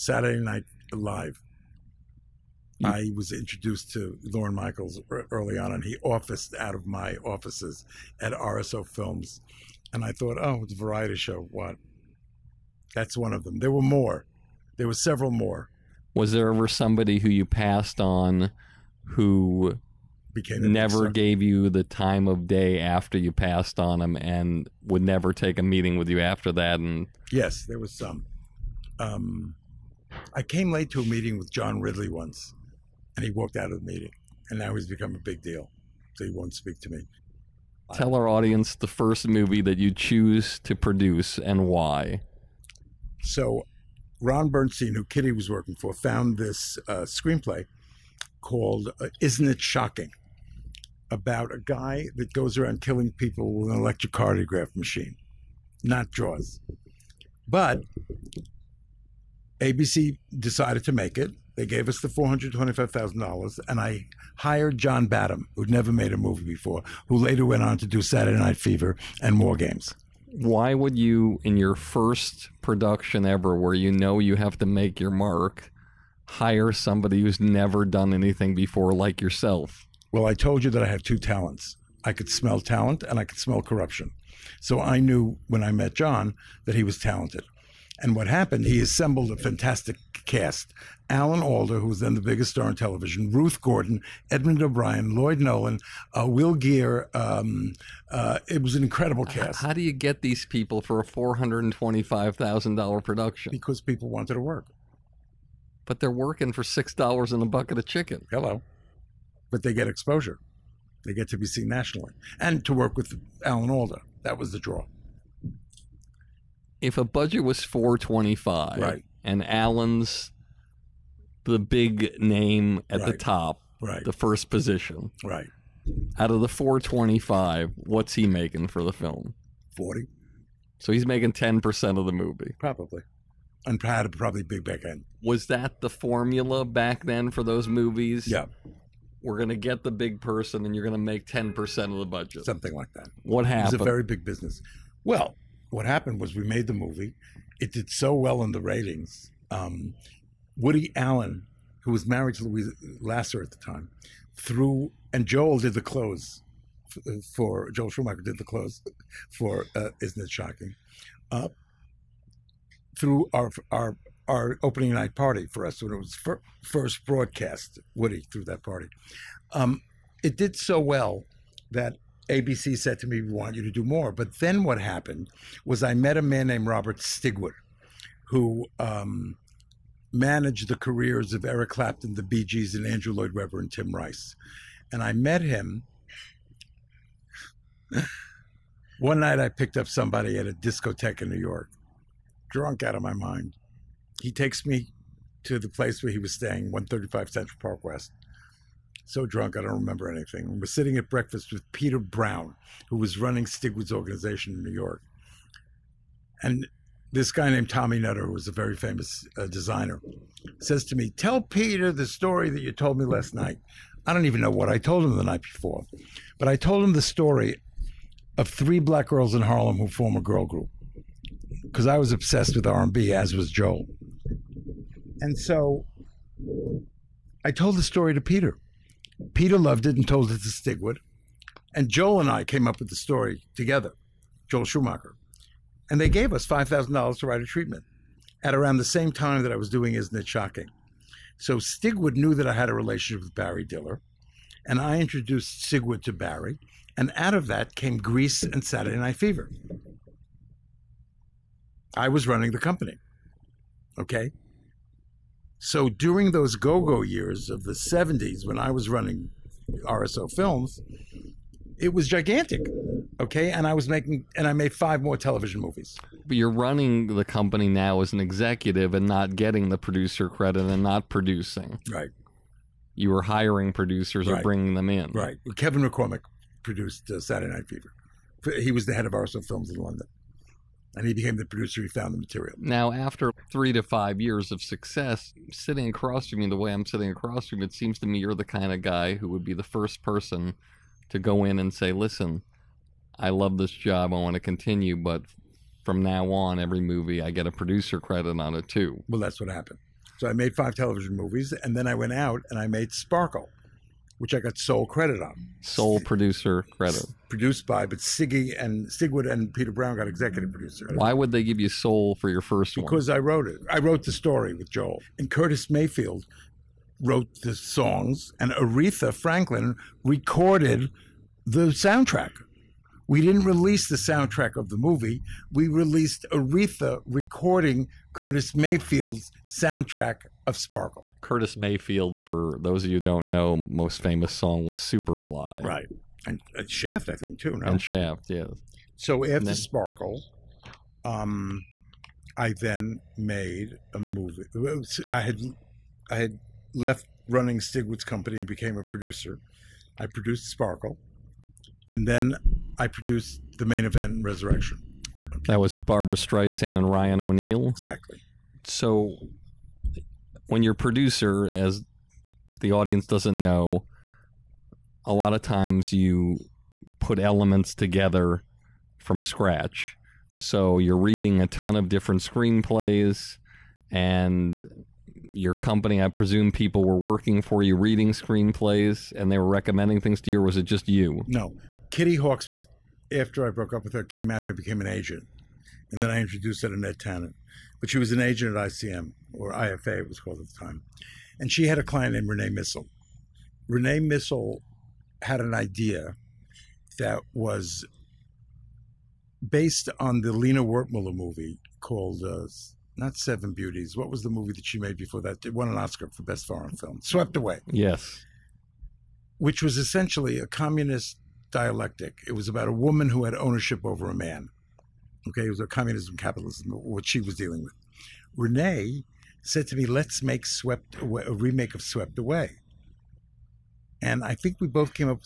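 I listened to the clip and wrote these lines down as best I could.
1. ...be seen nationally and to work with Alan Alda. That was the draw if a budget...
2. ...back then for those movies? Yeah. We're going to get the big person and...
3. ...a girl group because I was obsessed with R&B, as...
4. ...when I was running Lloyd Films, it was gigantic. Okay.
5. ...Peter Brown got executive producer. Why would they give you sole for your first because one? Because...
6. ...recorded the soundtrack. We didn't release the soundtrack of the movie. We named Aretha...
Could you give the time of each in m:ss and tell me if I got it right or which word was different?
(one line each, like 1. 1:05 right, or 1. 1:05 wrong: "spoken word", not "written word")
1. 1:51 right
2. 2:16 right
3. 3:40 right
4. 4:18 wrong: "RSO", not "Lloyd"
5. 5:09 right
6. 5:20 wrong: "released", not "named".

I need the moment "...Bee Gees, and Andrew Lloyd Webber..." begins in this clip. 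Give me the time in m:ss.
3:02.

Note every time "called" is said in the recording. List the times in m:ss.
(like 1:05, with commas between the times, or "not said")
0:48, 6:30, 6:41.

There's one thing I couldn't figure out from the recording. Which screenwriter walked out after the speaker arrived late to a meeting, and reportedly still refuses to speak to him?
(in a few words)
John Ridley.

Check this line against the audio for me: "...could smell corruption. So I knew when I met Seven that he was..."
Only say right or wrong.
wrong.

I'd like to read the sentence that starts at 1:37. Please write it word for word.
Um, uh, it was an incredible cast.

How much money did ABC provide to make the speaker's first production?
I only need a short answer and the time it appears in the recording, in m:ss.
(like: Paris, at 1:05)
$425,000, at 1:02.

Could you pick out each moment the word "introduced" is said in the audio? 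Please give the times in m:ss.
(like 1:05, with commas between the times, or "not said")
0:03, 4:04, 6:26.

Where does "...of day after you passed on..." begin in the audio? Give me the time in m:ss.
0:22.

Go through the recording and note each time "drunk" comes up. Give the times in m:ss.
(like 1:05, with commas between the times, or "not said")
3:12, 3:19.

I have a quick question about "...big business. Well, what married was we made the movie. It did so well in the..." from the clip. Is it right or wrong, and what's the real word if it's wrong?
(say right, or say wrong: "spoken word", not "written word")
wrong: "happened", not "married".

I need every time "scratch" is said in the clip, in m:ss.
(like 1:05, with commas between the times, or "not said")
6:09.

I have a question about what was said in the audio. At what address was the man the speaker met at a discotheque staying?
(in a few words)
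135 Central Park West.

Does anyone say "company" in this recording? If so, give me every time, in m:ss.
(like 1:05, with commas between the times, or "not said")
4:12, 4:27, 5:48, 6:15.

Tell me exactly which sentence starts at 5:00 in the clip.
So I made five television movies, and then I went out and I made Sparkle which I got sole credit on.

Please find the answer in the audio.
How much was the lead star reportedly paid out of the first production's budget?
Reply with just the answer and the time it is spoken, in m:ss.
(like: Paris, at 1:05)
40,000, at 2:09.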